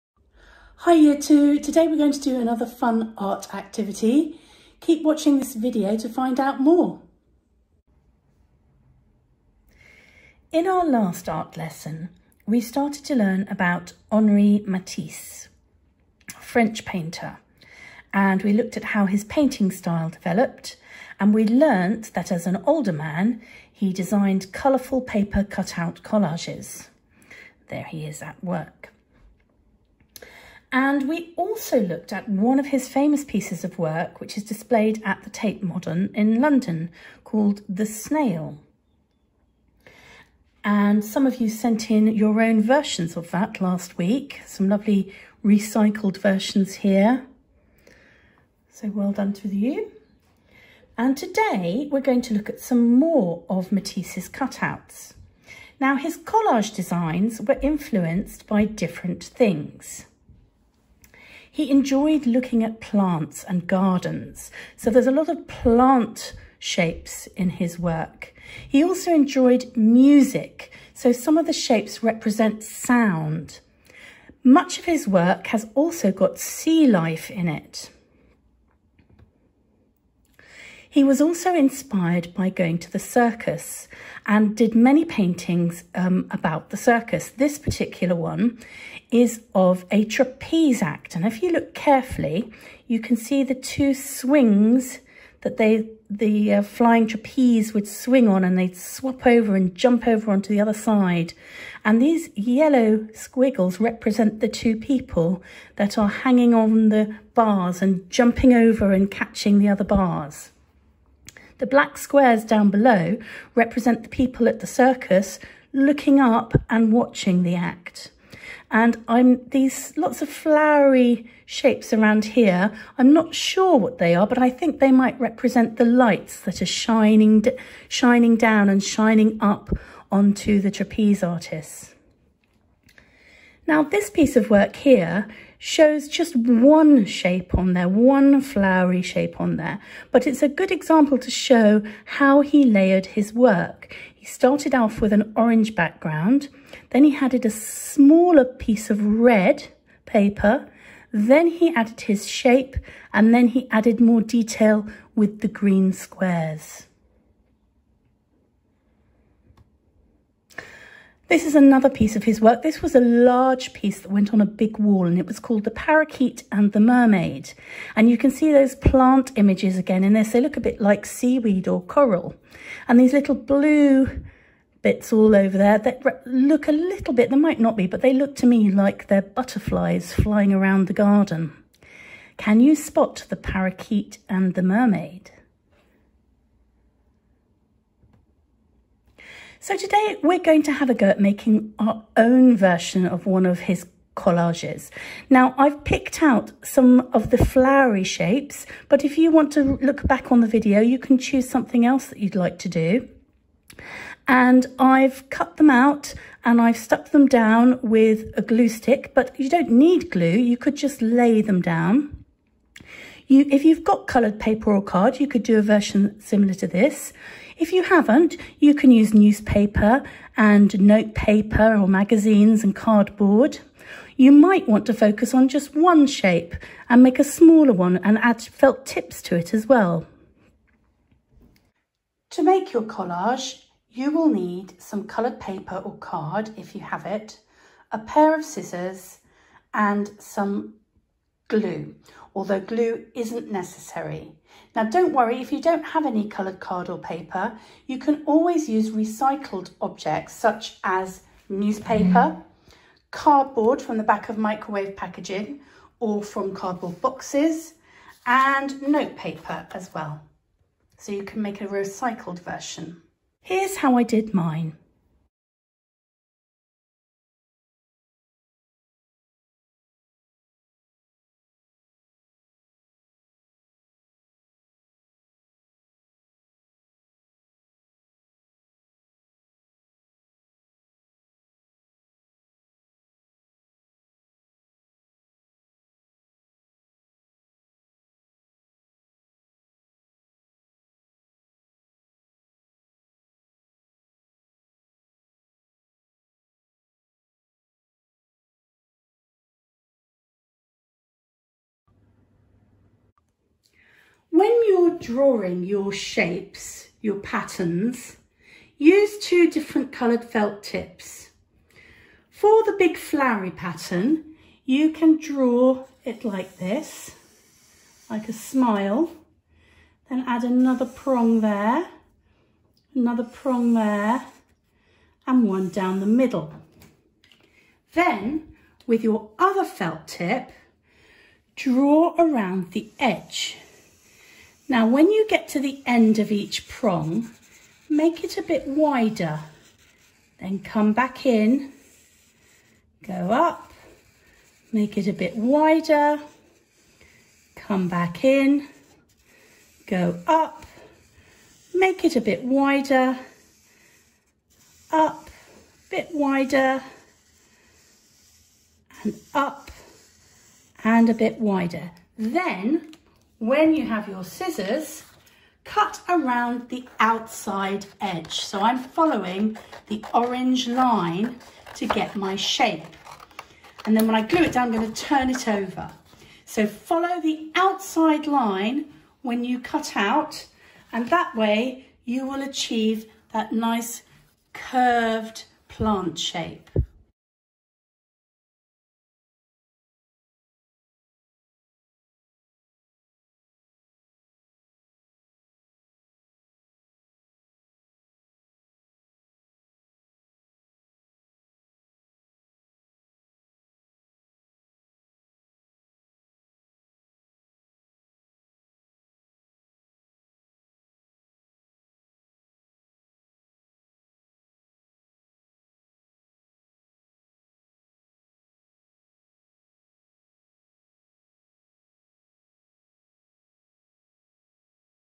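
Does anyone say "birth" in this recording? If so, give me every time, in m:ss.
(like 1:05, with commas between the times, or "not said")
not said.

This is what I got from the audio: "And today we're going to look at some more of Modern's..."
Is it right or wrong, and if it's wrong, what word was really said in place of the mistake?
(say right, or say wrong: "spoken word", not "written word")
wrong: "Matisse", not "Modern".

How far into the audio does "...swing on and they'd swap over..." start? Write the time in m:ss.
1:37.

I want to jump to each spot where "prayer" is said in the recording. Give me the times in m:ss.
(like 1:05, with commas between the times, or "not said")
not said.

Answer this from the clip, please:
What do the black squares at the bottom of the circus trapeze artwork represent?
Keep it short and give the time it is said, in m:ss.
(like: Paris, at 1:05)
People at the circus, at 1:54.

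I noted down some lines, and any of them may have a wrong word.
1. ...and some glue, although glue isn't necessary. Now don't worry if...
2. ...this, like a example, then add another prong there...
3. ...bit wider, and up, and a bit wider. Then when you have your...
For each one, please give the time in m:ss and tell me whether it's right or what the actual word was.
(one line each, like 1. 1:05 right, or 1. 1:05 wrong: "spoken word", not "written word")
1. 3:59 right
2. 5:16 wrong: "smile", not "example"
3. 5:55 right.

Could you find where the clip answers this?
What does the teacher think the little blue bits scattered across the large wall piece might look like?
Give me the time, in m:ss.
2:59.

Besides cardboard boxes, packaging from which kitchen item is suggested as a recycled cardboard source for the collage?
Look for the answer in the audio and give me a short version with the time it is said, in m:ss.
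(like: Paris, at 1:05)
Microwave packaging, at 4:14.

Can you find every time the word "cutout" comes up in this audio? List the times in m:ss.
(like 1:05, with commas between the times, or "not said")
0:25, 0:54.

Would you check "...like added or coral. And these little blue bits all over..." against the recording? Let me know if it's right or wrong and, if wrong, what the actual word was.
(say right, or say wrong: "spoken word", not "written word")
wrong: "seaweed", not "added".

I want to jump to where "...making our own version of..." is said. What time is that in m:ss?
3:11.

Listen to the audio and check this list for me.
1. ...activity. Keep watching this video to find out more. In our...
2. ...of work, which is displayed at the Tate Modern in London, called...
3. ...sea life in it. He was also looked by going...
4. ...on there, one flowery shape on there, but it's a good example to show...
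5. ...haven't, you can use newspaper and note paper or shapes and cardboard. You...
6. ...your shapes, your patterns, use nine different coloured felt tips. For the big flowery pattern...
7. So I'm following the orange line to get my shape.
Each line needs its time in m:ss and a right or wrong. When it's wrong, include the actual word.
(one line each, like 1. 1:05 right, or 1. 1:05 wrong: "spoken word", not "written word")
1. 0:03 right
2. 0:33 right
3. 1:16 wrong: "inspired", not "looked"
4. 2:17 right
5. 3:37 wrong: "magazines", not "shapes"
6. 5:05 wrong: "two", not "nine"
7. 6:08 right.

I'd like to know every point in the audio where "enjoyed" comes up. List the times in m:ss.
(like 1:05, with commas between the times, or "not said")
1:01, 1:09.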